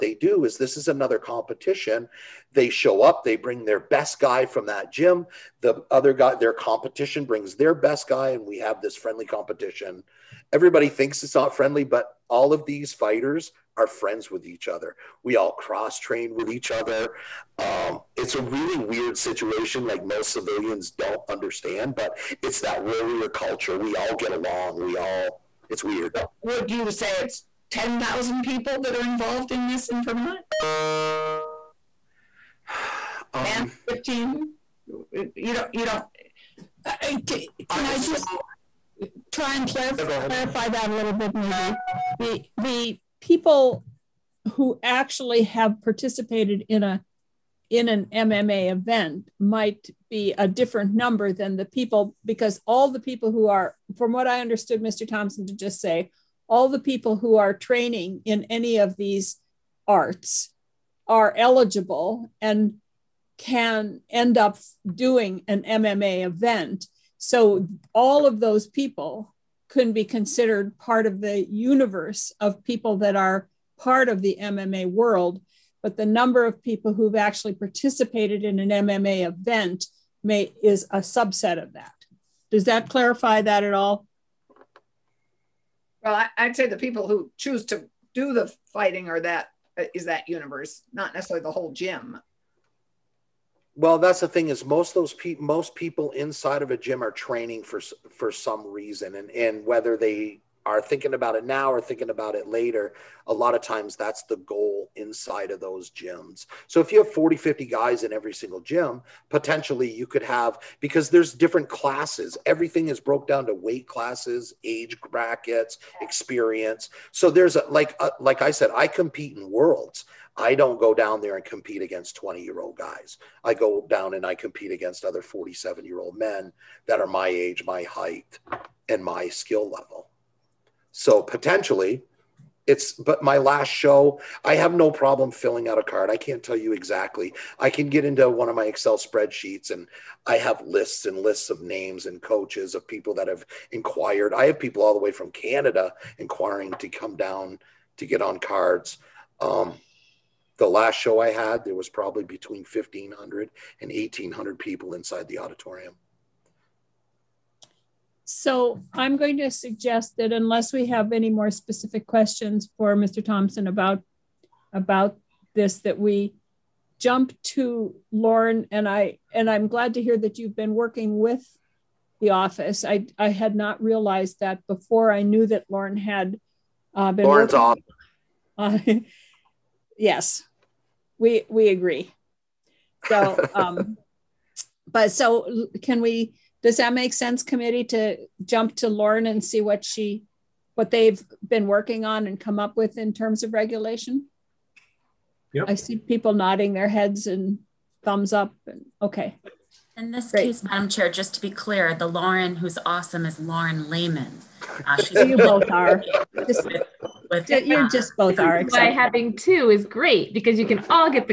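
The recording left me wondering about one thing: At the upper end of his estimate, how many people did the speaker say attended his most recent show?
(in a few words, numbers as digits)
1800.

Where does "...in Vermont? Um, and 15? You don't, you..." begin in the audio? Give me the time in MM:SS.
00:29.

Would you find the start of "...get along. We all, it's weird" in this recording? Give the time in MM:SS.
00:24.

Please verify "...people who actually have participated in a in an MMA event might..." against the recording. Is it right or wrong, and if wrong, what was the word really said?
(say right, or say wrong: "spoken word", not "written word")
right.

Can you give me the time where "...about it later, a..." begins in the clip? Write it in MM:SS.
01:42.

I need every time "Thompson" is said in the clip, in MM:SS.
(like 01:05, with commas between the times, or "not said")
00:55, 02:43.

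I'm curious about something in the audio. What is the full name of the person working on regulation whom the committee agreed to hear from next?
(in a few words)
Lauren Layman.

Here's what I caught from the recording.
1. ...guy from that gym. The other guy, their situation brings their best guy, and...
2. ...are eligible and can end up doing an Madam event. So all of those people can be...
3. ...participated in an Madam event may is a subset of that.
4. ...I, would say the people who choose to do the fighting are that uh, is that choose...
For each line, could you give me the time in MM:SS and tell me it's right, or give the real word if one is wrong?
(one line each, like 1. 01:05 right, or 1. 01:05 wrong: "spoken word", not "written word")
1. 00:04 wrong: "competition", not "situation"
2. 01:01 wrong: "MMA", not "Madam"
3. 01:17 wrong: "MMA", not "Madam"
4. 01:26 wrong: "universe", not "choose".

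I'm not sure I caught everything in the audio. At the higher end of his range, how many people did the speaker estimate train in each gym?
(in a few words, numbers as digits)
50.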